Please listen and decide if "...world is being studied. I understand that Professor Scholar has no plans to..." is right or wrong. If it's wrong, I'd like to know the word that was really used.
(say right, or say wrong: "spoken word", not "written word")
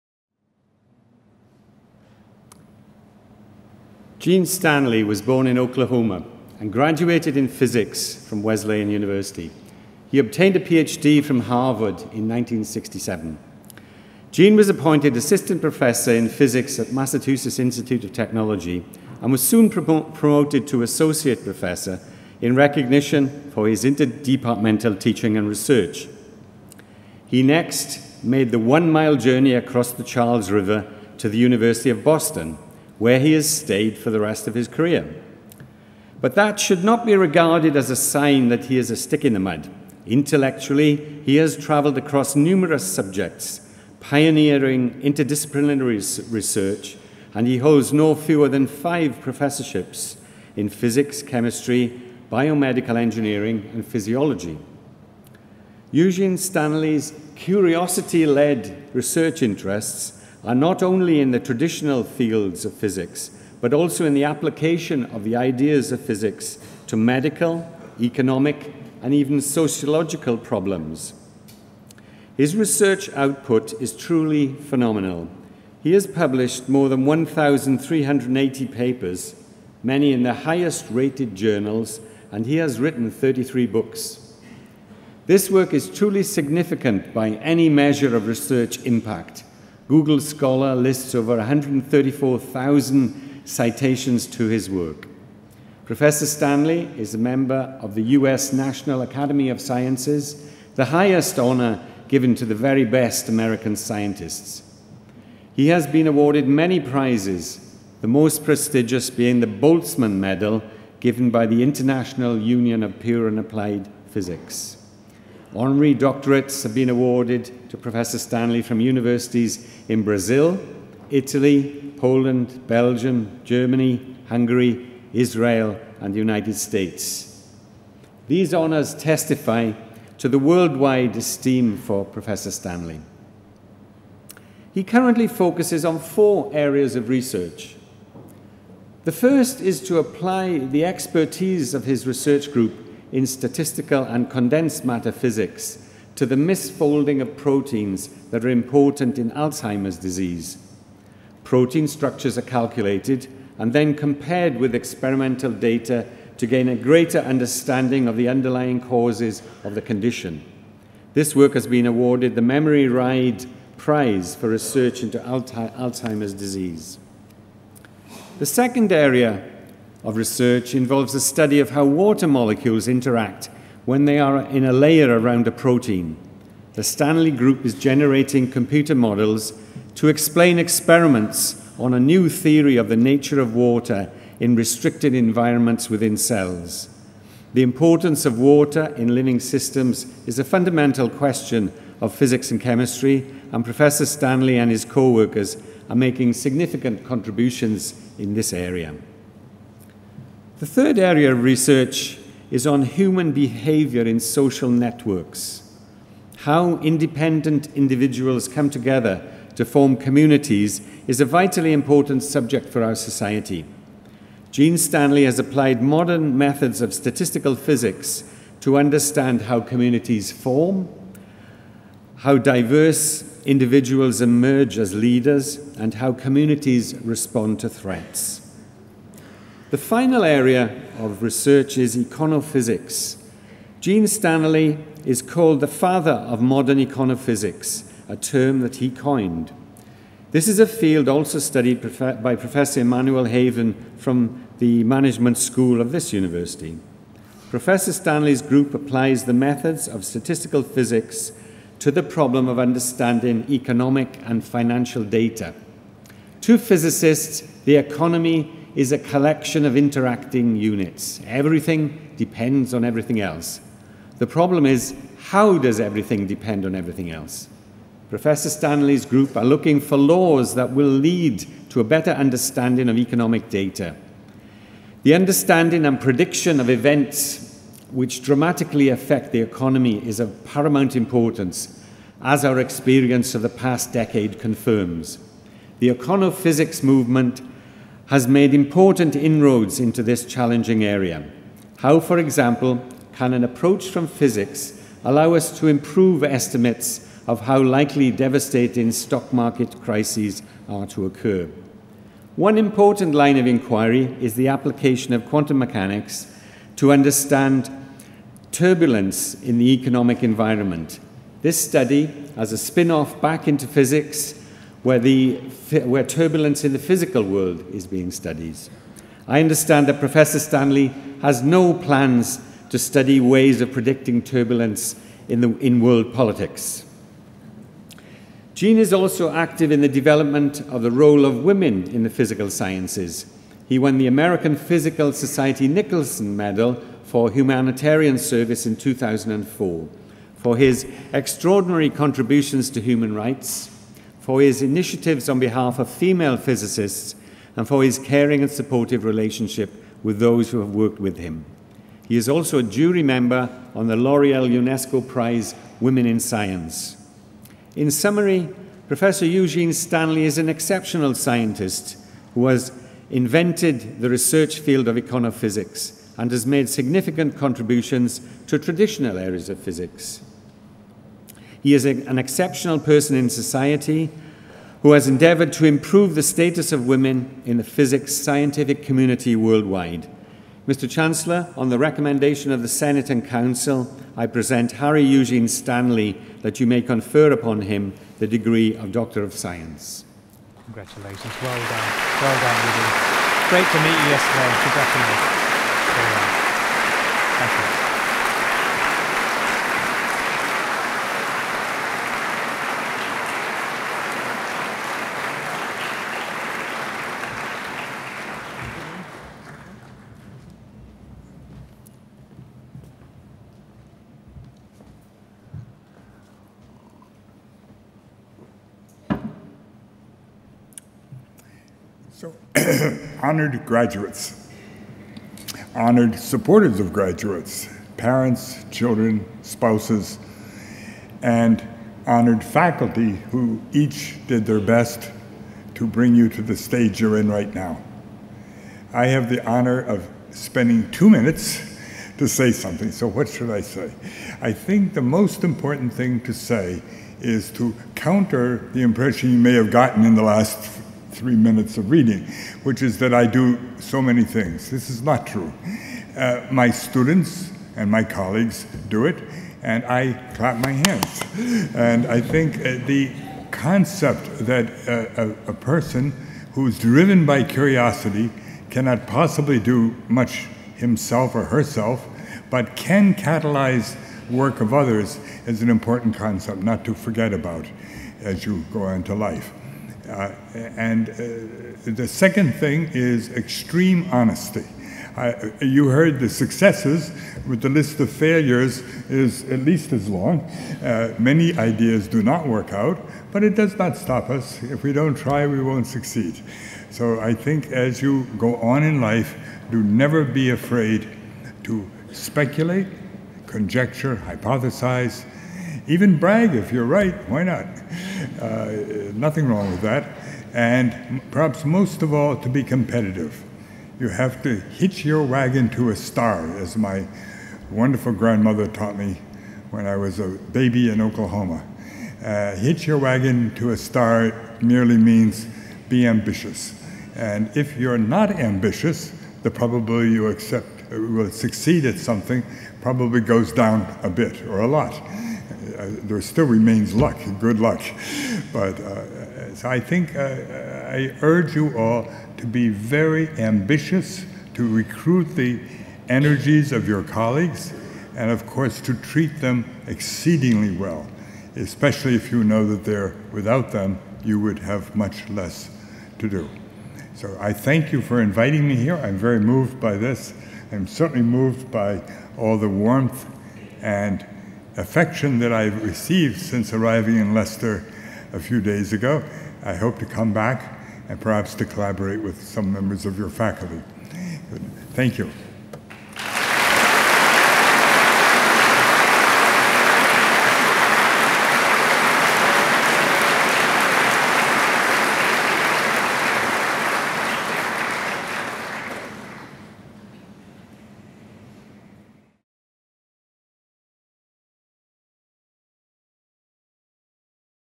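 wrong: "Stanley", not "Scholar".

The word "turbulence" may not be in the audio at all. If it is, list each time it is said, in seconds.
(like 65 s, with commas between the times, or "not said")
308 s, 316 s, 324 s.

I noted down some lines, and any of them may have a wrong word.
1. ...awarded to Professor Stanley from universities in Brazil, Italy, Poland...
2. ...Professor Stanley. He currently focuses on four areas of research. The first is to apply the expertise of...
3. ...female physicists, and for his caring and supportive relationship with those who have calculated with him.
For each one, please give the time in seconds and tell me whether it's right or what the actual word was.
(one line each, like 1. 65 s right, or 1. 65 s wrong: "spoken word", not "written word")
1. 116 s right
2. 132 s right
3. 345 s wrong: "worked", not "calculated".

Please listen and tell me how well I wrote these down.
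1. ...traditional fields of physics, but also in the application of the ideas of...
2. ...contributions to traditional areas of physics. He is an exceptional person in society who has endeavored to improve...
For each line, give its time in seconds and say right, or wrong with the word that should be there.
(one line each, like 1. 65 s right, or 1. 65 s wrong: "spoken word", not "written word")
1. 61 s right
2. 367 s right.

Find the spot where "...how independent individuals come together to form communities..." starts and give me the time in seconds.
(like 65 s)
206 s.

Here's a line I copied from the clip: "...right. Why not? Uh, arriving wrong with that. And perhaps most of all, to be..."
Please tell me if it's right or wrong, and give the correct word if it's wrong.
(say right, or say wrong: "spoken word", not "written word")
wrong: "nothing", not "arriving".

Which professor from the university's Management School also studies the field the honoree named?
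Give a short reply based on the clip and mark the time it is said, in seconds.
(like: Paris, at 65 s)
Emmanuel Haven, at 242 s.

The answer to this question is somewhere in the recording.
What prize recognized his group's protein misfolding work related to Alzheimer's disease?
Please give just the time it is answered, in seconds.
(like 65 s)
162 s.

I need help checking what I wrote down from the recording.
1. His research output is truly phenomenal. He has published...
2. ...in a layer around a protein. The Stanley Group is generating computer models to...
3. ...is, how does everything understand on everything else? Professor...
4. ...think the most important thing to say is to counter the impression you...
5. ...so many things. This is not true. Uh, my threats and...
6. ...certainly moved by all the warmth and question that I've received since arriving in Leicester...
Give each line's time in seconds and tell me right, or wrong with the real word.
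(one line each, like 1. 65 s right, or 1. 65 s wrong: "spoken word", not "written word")
1. 72 s right
2. 174 s right
3. 264 s wrong: "depend", not "understand"
4. 444 s right
5. 453 s wrong: "students", not "threats"
6. 560 s wrong: "affection", not "question".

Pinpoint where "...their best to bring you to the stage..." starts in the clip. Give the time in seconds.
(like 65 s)
434 s.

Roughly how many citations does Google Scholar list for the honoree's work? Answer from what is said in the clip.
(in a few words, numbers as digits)
134,000.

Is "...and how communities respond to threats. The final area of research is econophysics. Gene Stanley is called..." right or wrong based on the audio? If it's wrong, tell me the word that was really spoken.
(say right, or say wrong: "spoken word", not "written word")
right.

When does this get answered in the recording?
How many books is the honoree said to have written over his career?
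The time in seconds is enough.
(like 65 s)
83 s.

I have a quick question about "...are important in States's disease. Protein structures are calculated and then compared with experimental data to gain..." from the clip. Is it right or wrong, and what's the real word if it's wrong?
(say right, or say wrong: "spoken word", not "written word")
wrong: "Alzheimer", not "States".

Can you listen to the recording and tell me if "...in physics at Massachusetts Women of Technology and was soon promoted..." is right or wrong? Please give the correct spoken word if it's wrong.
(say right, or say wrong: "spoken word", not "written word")
wrong: "Institute", not "Women".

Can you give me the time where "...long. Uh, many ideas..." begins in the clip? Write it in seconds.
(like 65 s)
490 s.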